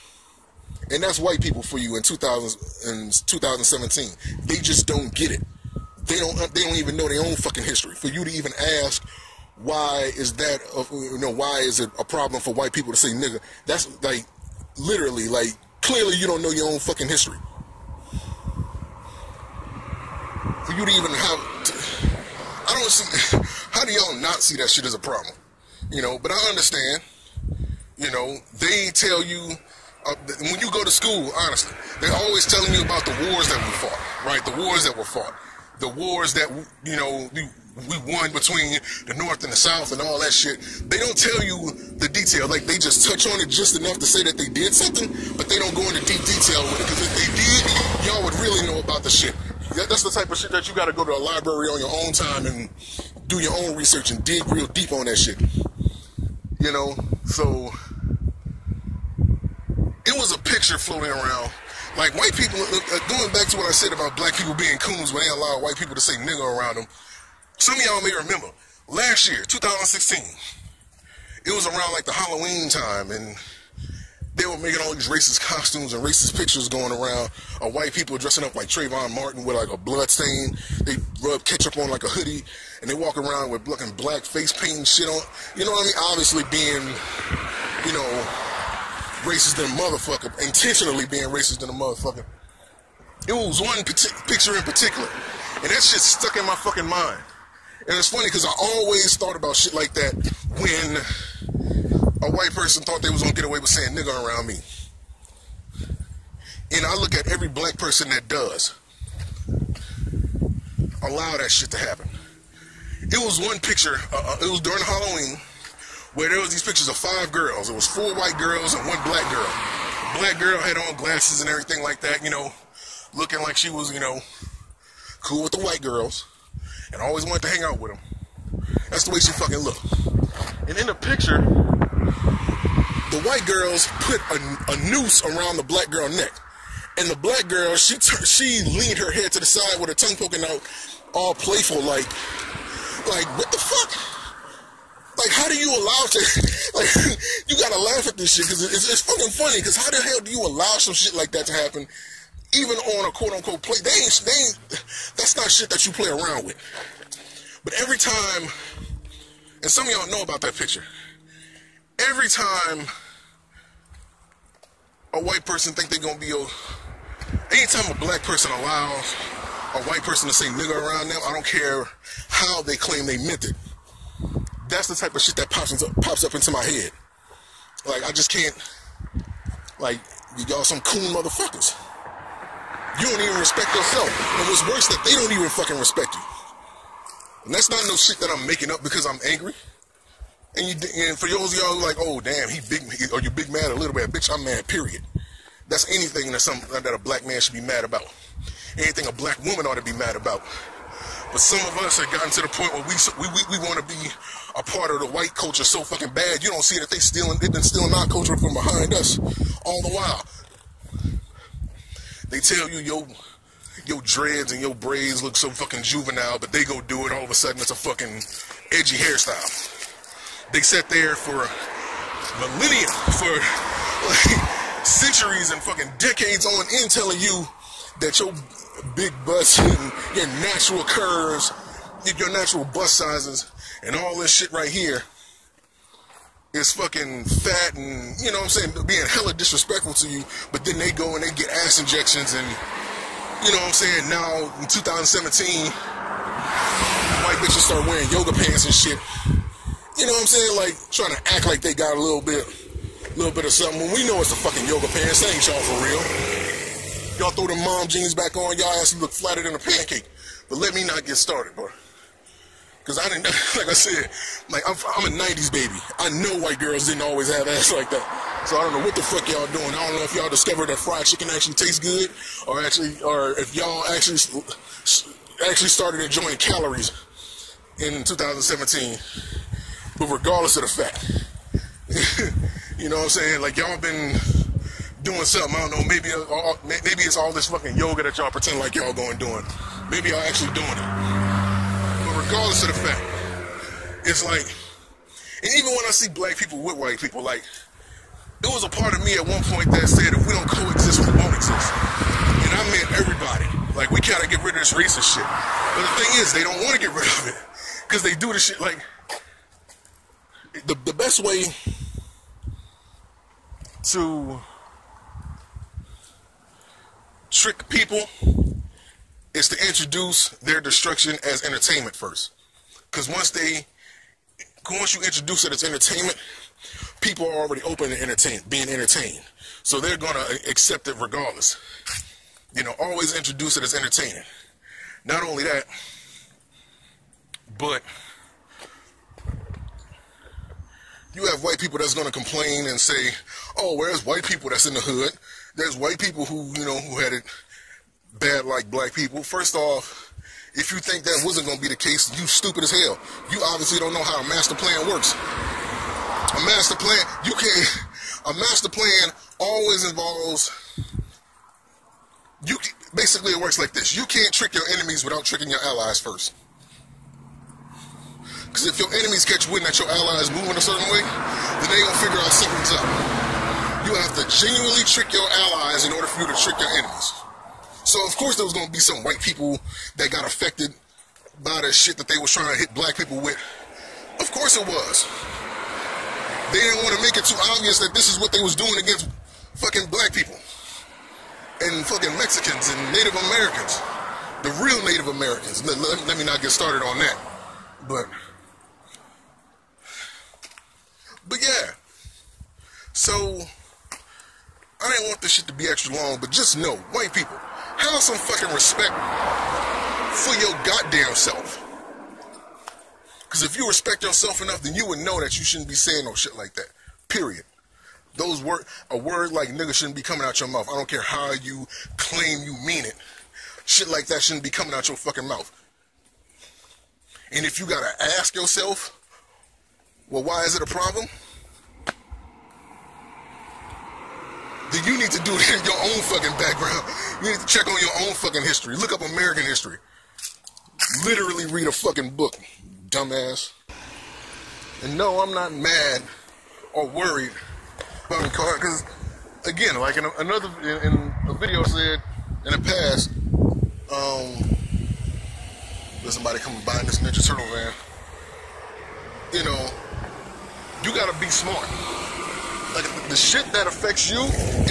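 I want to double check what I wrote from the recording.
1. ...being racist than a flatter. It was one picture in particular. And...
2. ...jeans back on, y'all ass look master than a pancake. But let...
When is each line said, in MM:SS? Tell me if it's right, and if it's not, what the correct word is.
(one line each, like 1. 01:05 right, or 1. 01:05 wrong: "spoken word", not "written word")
1. 01:31 wrong: "motherfucker", not "flatter"
2. 04:17 wrong: "flatter", not "master".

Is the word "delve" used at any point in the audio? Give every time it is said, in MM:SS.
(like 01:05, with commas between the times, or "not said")
not said.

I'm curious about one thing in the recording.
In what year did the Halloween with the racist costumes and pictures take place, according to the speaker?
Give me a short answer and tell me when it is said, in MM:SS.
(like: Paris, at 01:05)
2016, at 01:09.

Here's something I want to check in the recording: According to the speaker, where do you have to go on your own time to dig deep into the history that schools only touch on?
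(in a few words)
a library.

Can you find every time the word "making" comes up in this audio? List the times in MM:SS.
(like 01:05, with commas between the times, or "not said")
01:14, 03:08.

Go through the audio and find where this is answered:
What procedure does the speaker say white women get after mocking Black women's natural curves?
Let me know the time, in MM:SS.
04:01.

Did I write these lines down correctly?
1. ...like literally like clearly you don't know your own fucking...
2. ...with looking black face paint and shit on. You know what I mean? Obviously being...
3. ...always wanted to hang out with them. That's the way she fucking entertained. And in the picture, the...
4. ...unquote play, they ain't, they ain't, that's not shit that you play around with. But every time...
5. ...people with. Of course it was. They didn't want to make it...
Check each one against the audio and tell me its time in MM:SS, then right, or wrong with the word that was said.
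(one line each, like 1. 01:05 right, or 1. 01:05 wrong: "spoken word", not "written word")
1. 00:14 right
2. 01:23 right
3. 02:07 wrong: "looked", not "entertained"
4. 02:33 right
5. 06:22 right.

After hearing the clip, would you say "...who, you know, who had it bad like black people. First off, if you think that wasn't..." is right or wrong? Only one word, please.
right.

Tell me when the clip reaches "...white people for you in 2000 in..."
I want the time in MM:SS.
00:01.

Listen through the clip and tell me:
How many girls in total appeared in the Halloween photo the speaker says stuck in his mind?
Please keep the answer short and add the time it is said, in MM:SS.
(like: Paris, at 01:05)
5, at 01:56.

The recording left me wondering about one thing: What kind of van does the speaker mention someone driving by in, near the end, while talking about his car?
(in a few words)
Ninja Turtle van.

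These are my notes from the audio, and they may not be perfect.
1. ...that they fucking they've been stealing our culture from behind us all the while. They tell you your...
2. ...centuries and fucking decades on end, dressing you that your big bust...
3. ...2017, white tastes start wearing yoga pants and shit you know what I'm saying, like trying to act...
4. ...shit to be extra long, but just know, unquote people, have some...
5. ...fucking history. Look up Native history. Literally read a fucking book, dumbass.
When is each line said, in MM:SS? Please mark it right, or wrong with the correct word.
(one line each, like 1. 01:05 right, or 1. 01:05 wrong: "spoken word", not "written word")
1. 03:26 wrong: "stealing", not "fucking"
2. 03:44 wrong: "telling", not "dressing"
3. 04:04 wrong: "bitches", not "tastes"
4. 06:45 wrong: "white", not "unquote"
5. 07:18 wrong: "American", not "Native".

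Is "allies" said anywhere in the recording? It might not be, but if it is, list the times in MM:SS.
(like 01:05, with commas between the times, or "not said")
06:05, 06:09, 06:15.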